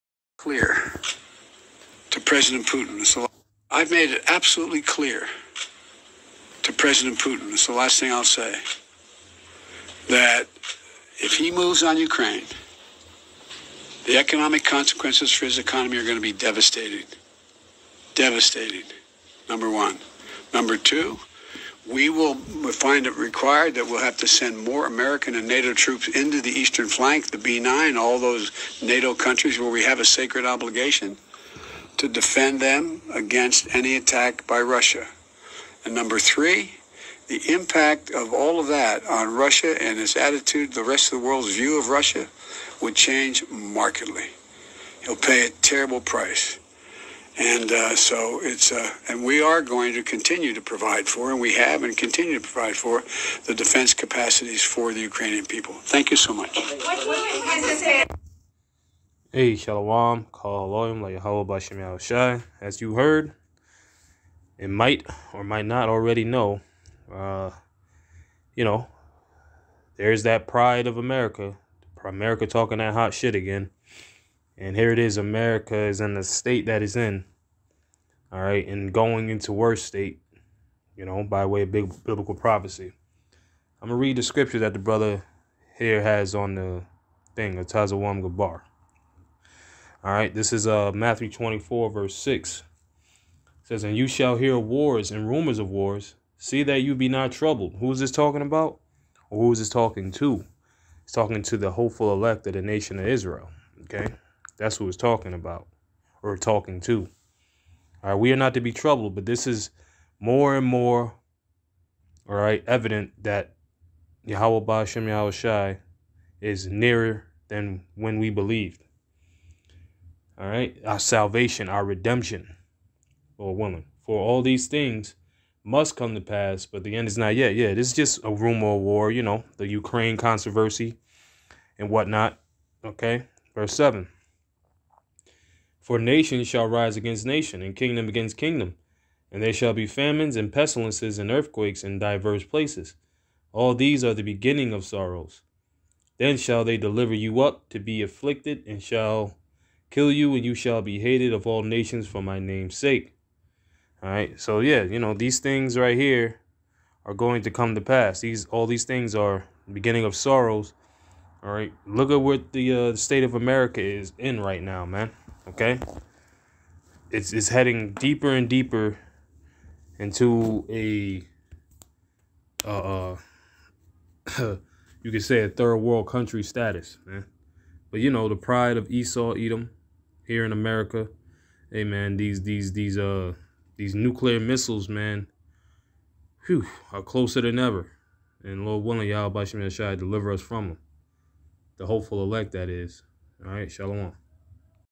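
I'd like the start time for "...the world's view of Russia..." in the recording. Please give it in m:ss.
0:41.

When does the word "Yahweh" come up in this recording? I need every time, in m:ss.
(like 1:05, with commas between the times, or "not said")
1:54, 3:09.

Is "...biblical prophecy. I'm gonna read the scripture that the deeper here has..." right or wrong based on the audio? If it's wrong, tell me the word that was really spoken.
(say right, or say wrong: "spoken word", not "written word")
wrong: "brother", not "deeper".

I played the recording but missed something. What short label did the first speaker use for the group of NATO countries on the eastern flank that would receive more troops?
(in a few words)
B9.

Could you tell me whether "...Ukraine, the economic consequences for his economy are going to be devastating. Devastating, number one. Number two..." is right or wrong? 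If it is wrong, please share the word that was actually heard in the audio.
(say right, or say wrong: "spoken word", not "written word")
right.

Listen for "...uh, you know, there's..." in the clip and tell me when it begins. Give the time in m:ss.
1:07.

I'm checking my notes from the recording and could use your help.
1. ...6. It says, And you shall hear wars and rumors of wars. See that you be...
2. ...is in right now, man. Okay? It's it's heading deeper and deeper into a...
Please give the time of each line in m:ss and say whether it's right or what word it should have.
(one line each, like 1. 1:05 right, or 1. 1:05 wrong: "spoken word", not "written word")
1. 1:32 right
2. 2:43 right.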